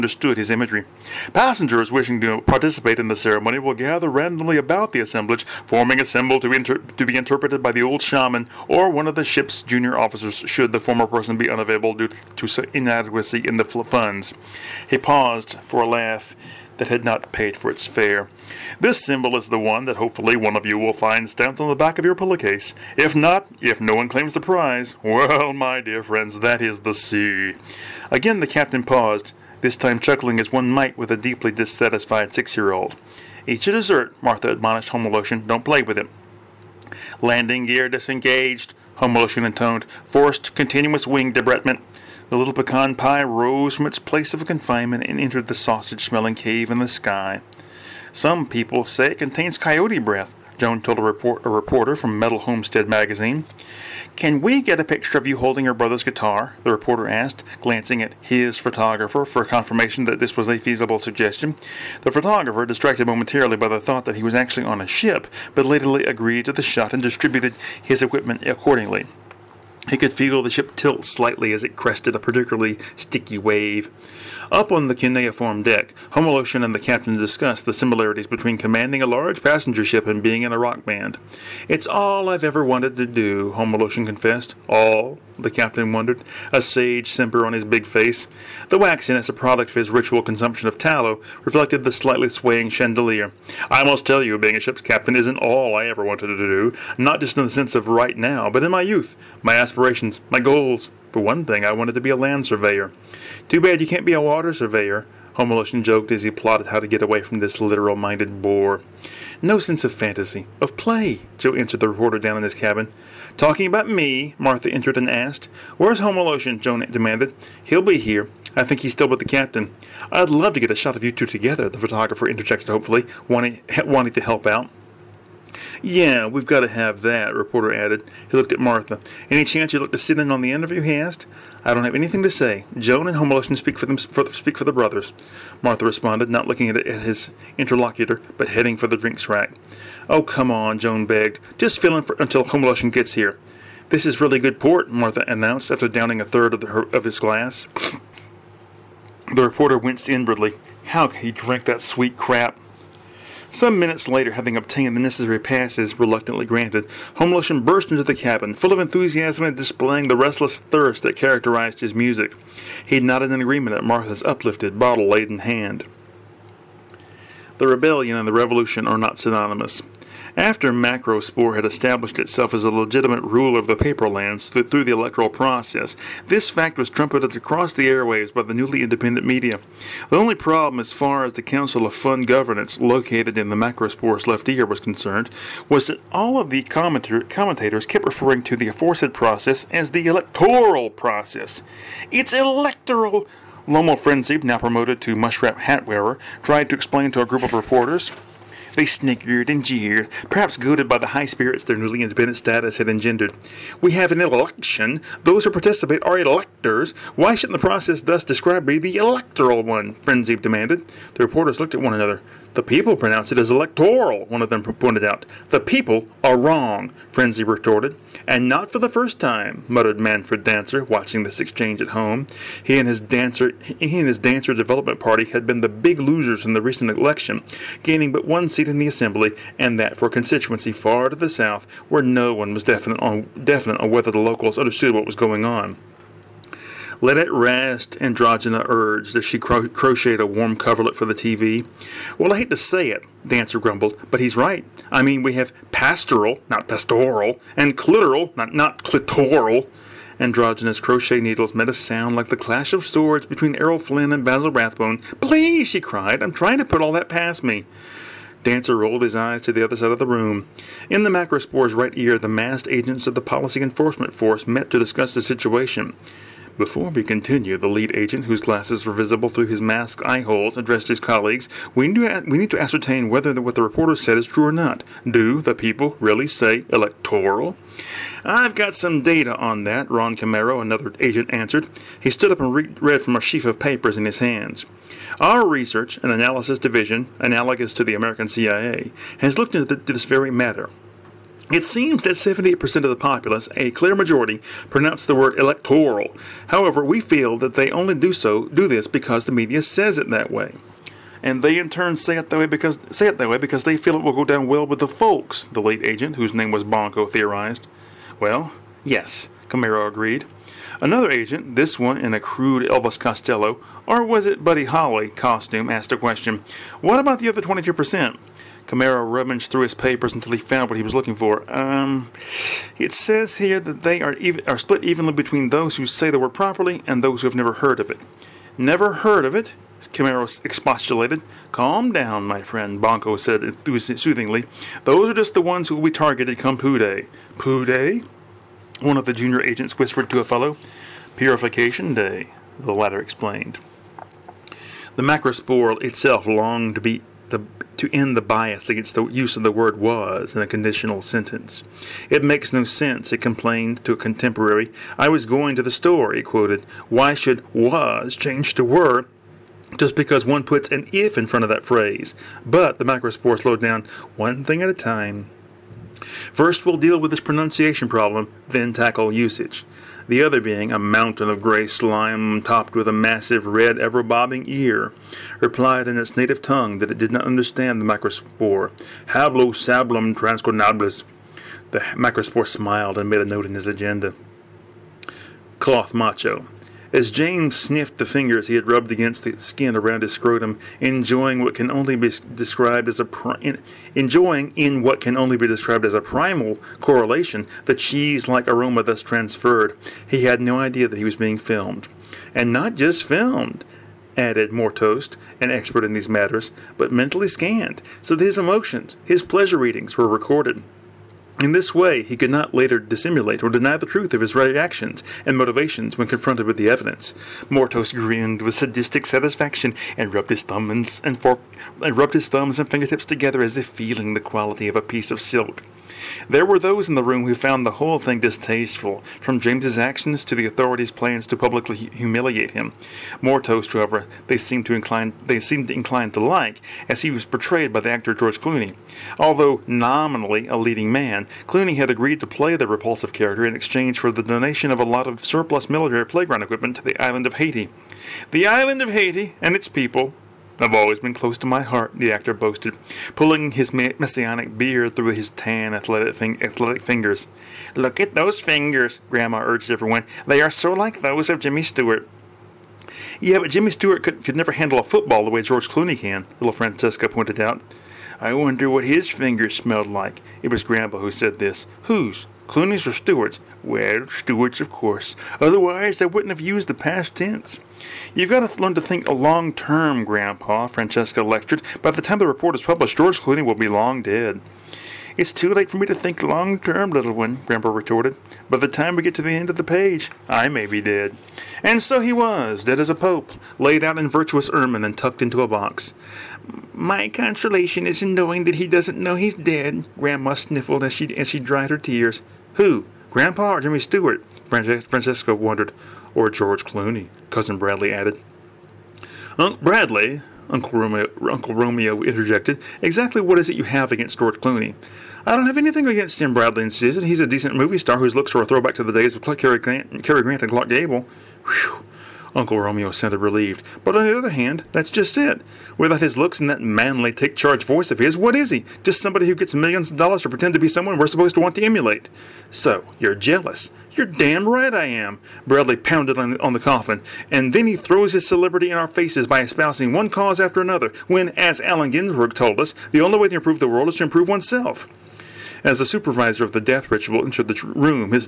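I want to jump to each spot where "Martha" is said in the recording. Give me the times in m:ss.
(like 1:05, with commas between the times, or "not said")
0:34, 1:54, 2:08, 2:15, 2:24, 2:43.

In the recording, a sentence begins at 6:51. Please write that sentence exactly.
In this way, he could not later dissimulate or deny the truth of his reactions and motivations when confronted with the evidence.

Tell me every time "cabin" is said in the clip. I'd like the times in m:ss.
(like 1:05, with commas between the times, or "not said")
1:52, 2:38.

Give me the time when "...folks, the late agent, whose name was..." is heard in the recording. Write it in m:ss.
5:04.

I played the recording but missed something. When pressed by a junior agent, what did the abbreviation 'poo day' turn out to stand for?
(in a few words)
Purification day.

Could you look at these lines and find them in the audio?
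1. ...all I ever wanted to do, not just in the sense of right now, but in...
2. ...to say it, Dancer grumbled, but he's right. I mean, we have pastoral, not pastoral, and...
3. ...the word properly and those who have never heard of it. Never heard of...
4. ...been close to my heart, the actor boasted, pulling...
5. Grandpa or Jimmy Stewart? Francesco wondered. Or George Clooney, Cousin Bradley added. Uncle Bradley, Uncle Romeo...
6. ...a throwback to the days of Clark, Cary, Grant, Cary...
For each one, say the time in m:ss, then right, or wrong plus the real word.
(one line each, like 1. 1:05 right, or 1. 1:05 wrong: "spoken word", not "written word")
1. 1:35 right
2. 4:02 right
3. 5:26 right
4. 7:30 right
5. 8:23 right
6. 8:38 right.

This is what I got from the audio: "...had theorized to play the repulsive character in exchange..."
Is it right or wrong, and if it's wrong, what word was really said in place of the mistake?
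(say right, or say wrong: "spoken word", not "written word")
wrong: "agreed", not "theorized".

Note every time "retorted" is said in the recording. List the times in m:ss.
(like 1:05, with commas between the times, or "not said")
3:37, 8:07.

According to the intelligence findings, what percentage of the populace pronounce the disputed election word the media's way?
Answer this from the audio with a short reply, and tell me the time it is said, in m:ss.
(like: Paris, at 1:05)
78%, at 4:52.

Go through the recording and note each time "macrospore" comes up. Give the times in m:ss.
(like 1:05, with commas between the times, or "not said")
2:50, 3:03, 4:21, 5:45.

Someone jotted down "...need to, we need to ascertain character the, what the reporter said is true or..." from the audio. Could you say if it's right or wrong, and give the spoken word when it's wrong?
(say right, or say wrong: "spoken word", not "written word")
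wrong: "whether", not "character".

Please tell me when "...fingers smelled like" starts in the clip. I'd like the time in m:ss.
7:49.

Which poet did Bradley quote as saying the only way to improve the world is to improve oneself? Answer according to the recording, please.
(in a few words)
Allen Ginsberg.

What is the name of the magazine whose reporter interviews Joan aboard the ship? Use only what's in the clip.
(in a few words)
Metal Homestead.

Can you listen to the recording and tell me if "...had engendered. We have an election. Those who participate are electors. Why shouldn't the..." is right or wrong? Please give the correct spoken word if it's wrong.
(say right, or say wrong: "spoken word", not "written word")
right.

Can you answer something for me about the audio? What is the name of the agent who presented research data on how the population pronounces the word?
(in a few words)
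Ron Camaro.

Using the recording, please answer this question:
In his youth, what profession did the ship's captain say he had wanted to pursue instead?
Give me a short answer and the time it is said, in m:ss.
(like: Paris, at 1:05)
land surveyor, at 1:42.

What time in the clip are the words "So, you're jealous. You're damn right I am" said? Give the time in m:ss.
8:52.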